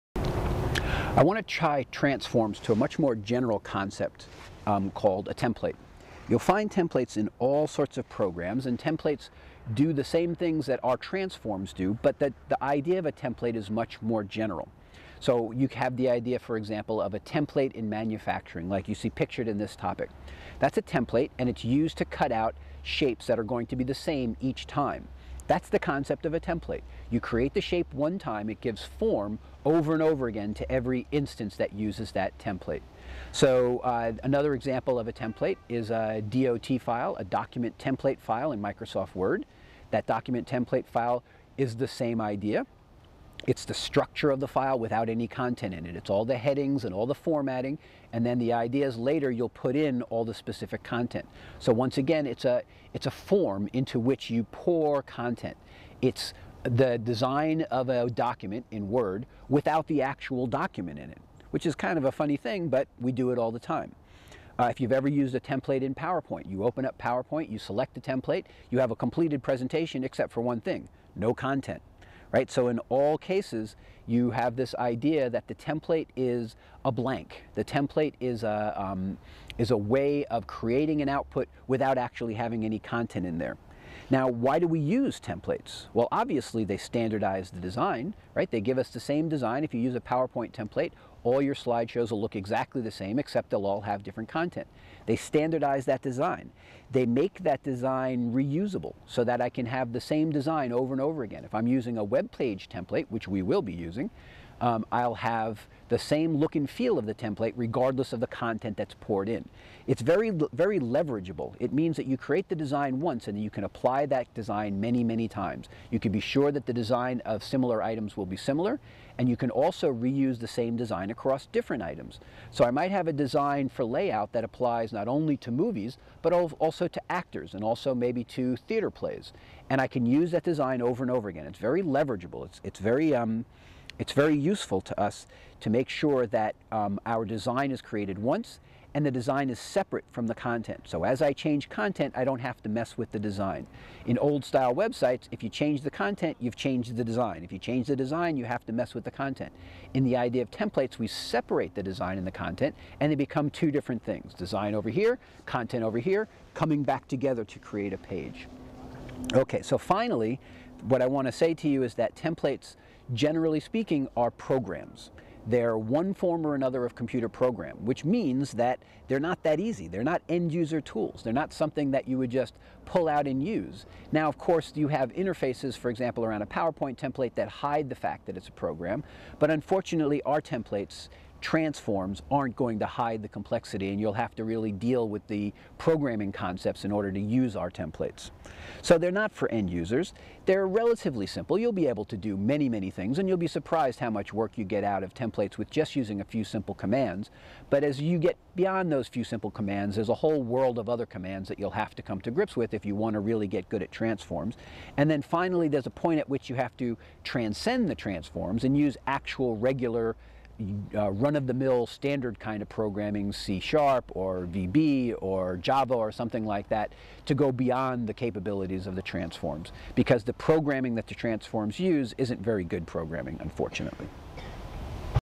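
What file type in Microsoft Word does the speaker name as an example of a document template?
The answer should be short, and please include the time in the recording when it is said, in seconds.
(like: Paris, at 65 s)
DOT file, at 36 s.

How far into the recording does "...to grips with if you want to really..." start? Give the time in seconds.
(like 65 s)
202 s.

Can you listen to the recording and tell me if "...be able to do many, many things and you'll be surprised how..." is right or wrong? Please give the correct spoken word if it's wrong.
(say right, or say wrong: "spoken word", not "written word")
right.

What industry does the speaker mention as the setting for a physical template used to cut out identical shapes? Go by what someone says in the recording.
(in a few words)
manufacturing.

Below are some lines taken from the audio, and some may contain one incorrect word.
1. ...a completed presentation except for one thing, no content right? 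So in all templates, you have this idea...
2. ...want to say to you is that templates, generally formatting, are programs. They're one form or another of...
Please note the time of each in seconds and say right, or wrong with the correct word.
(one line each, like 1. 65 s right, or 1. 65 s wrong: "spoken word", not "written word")
1. 68 s wrong: "cases", not "templates"
2. 161 s wrong: "speaking", not "formatting".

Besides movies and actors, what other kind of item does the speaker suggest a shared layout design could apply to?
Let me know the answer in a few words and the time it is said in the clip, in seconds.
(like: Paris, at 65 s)
theater plays, at 128 s.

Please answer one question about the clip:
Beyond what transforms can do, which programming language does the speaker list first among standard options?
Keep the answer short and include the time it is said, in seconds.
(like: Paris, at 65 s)
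C Sharp, at 213 s.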